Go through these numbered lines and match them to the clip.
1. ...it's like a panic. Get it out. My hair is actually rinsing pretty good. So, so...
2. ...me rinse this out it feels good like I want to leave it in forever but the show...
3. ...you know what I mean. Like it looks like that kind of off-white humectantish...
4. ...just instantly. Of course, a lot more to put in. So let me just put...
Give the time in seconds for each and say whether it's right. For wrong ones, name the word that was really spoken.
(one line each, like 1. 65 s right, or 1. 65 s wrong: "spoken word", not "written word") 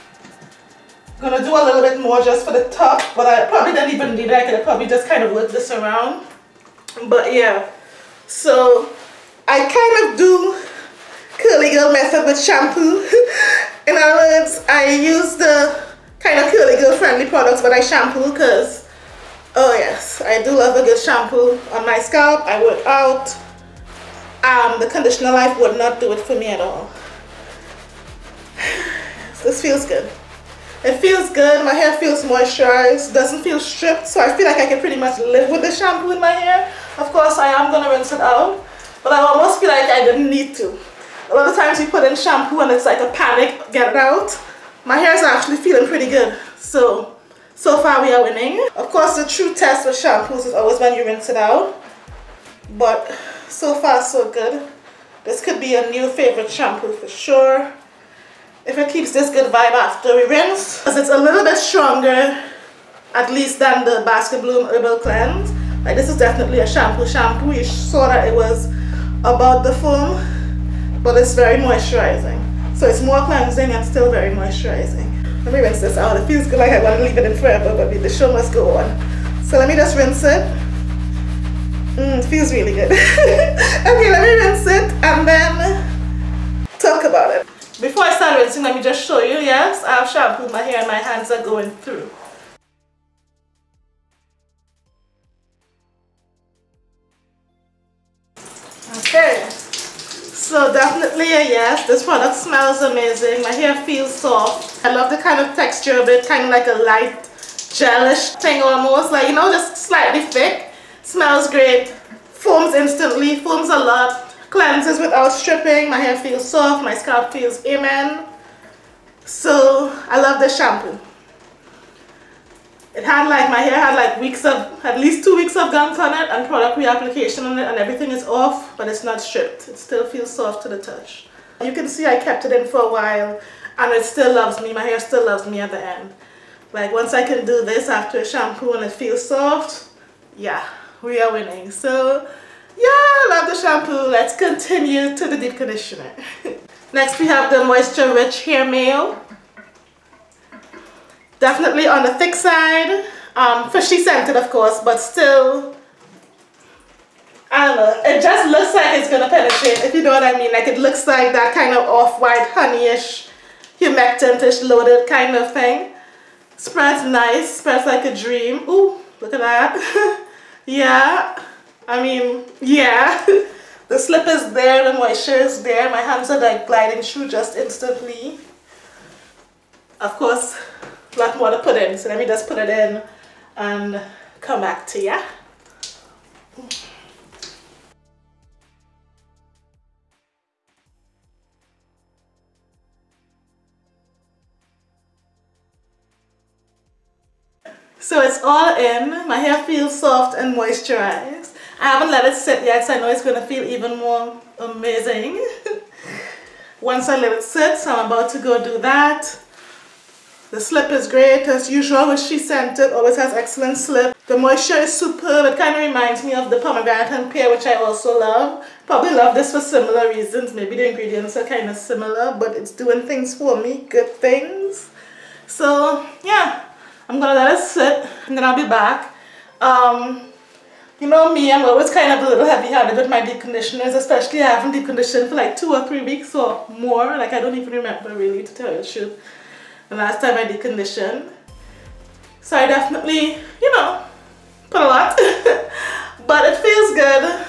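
1. 42 s wrong: "feeling", not "rinsing"
2. 75 s right
3. 159 s wrong: "honeyish", not "humectantish"
4. 177 s right.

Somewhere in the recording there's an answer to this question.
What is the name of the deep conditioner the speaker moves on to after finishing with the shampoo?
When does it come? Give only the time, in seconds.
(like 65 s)
147 s.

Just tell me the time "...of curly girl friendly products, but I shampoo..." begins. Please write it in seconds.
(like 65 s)
16 s.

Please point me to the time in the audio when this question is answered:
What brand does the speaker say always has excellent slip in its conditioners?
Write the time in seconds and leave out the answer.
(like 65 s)
212 s.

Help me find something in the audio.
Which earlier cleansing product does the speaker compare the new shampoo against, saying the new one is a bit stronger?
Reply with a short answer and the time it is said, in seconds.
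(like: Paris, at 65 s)
Basket Bloom Herbal Cleanse, at 64 s.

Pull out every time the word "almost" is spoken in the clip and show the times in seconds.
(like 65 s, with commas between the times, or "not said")
39 s, 108 s.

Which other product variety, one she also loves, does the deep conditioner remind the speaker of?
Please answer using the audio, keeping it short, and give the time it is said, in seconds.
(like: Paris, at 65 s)
pomegranate and pear, at 216 s.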